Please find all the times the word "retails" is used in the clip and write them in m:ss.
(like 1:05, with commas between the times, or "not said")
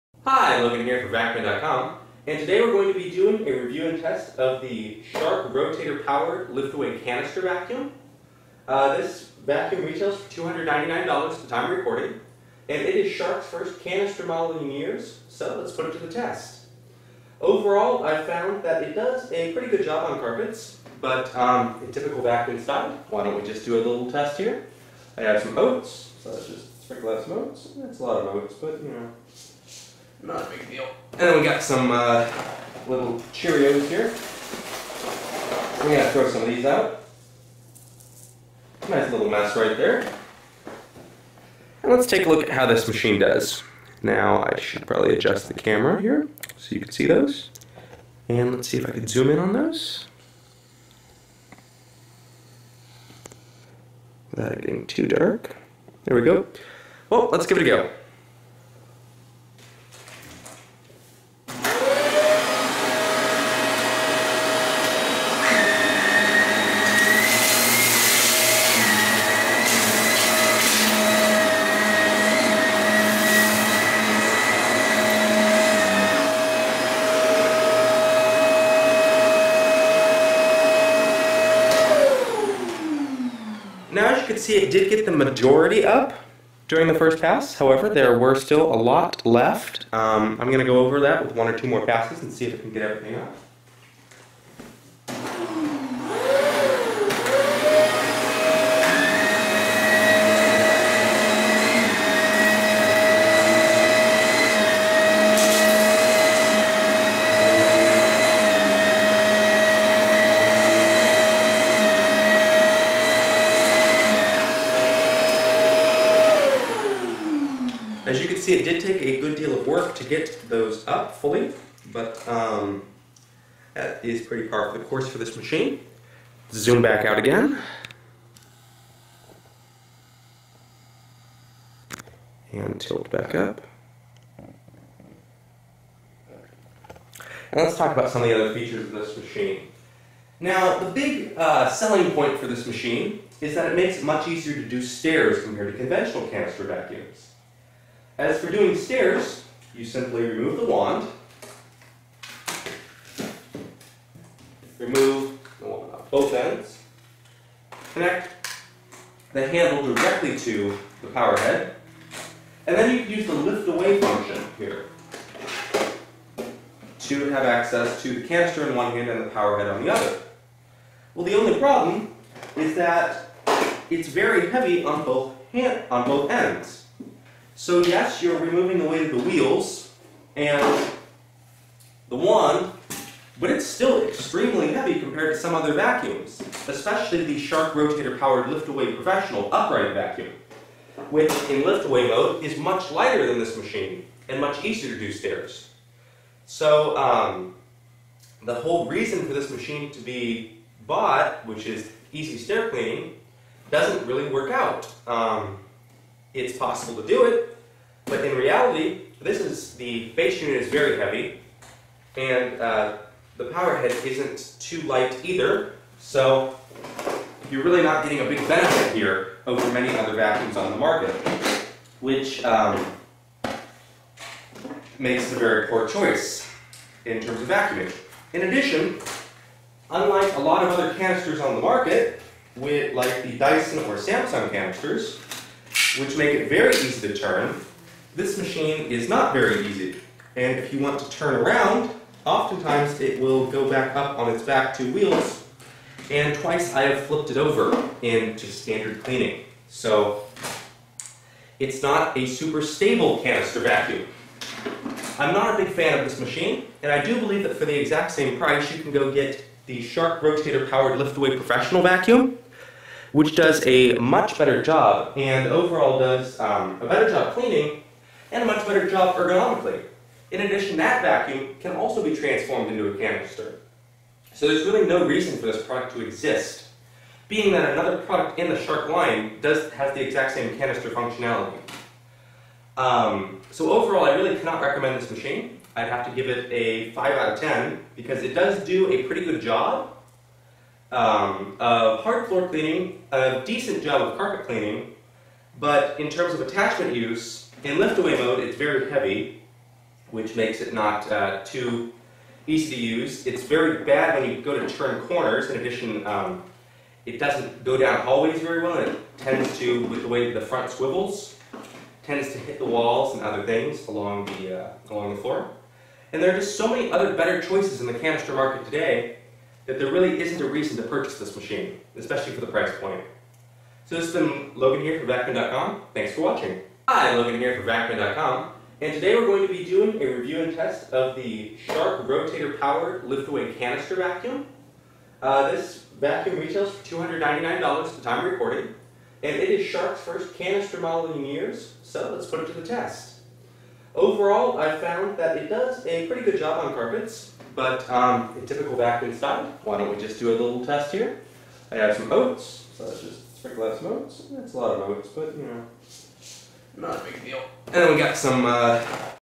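0:09, 5:36.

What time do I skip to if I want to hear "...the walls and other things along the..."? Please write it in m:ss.
5:12.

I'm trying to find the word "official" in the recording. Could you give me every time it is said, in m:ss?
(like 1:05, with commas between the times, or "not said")
not said.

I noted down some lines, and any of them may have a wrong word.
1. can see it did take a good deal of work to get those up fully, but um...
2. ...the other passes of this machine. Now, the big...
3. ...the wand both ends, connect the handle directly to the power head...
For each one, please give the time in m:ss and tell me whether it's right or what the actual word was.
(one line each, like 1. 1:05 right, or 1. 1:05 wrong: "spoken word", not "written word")
1. 1:58 right
2. 2:18 wrong: "features", not "passes"
3. 2:35 right.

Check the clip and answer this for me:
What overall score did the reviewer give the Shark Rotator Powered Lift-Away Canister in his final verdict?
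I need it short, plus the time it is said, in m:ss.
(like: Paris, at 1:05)
5 out of 10, at 4:46.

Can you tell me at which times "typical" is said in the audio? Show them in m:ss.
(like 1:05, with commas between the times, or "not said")
0:21, 5:48.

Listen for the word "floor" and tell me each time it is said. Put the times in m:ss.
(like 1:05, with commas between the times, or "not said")
4:52, 5:15.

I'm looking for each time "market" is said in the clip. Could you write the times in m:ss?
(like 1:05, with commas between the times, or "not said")
3:40, 3:51, 5:18.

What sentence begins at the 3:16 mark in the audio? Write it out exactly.
So um, the whole reason for this machine to be bought, which is easy stair cleaning, doesn't really work out.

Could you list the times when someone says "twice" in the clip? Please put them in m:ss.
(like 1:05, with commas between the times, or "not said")
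4:06.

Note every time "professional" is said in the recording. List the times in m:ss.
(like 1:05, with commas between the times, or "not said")
3:08, 4:21.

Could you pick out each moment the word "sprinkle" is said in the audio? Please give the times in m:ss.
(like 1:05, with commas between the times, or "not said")
0:26, 5:53.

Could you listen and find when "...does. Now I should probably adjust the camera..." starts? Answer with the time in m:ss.
0:43.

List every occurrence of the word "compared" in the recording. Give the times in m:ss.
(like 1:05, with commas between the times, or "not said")
2:25, 3:04.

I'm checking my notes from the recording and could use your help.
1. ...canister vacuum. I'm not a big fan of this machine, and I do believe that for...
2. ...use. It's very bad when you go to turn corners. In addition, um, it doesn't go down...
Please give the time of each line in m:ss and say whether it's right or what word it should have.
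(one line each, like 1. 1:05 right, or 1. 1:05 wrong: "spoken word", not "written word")
1. 4:13 right
2. 5:02 right.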